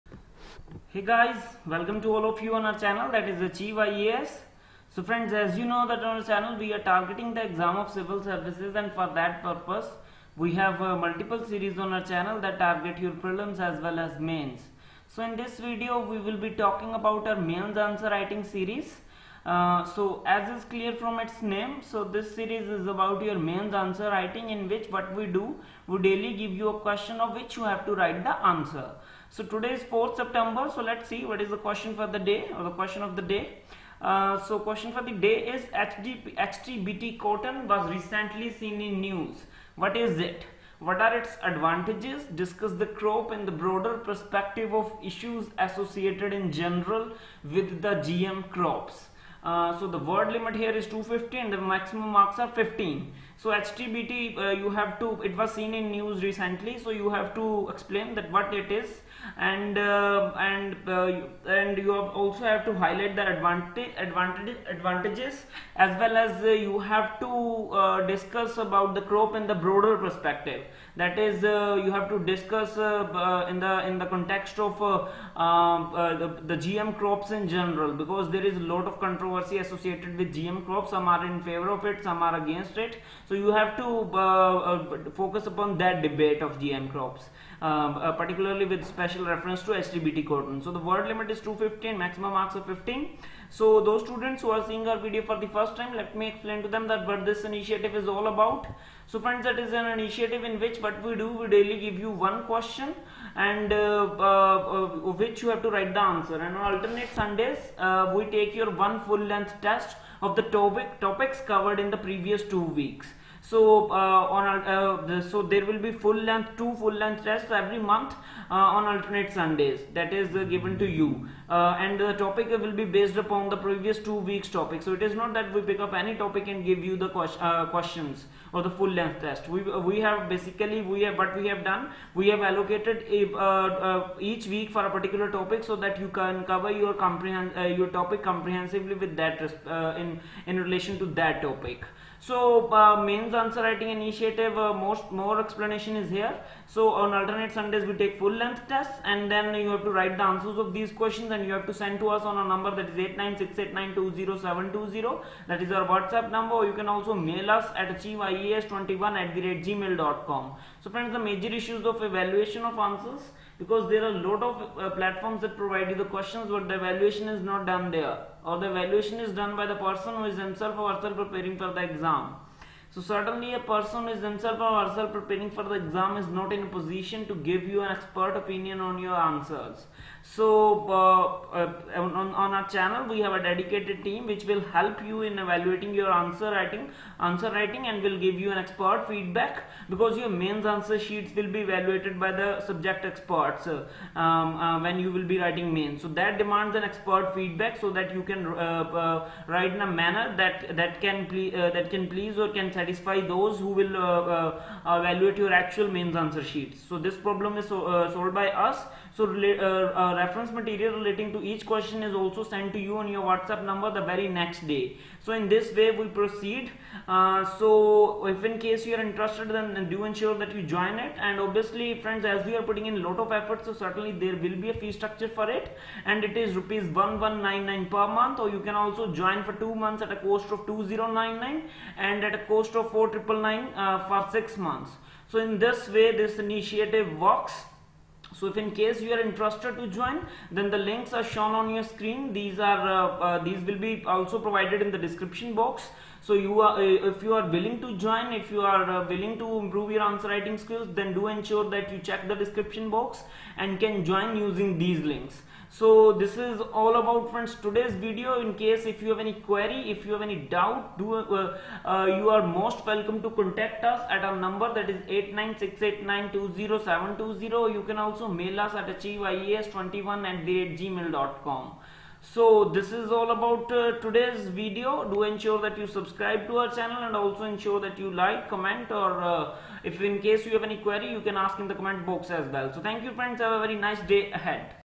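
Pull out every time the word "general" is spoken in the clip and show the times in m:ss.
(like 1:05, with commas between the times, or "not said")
0:46, 1:17.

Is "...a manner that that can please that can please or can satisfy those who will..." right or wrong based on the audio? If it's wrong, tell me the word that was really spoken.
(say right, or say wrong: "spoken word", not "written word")
right.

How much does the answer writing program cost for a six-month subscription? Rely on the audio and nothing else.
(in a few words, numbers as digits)
4999.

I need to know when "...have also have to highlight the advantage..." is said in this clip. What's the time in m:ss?
1:01.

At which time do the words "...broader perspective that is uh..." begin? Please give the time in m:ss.
1:09.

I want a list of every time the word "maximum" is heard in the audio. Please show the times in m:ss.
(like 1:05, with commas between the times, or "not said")
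0:51, 1:31.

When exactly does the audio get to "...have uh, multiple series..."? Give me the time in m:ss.
0:10.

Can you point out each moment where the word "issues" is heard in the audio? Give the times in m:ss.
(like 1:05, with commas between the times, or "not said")
0:45, 2:41.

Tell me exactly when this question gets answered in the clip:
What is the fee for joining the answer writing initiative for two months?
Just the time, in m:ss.
3:50.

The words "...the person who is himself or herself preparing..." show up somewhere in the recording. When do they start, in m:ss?
2:49.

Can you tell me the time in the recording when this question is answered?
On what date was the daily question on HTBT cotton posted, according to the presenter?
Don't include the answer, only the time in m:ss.
0:29.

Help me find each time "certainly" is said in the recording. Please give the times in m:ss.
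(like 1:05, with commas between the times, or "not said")
2:52, 3:43.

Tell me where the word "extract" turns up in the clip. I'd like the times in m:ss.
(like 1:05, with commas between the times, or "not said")
not said.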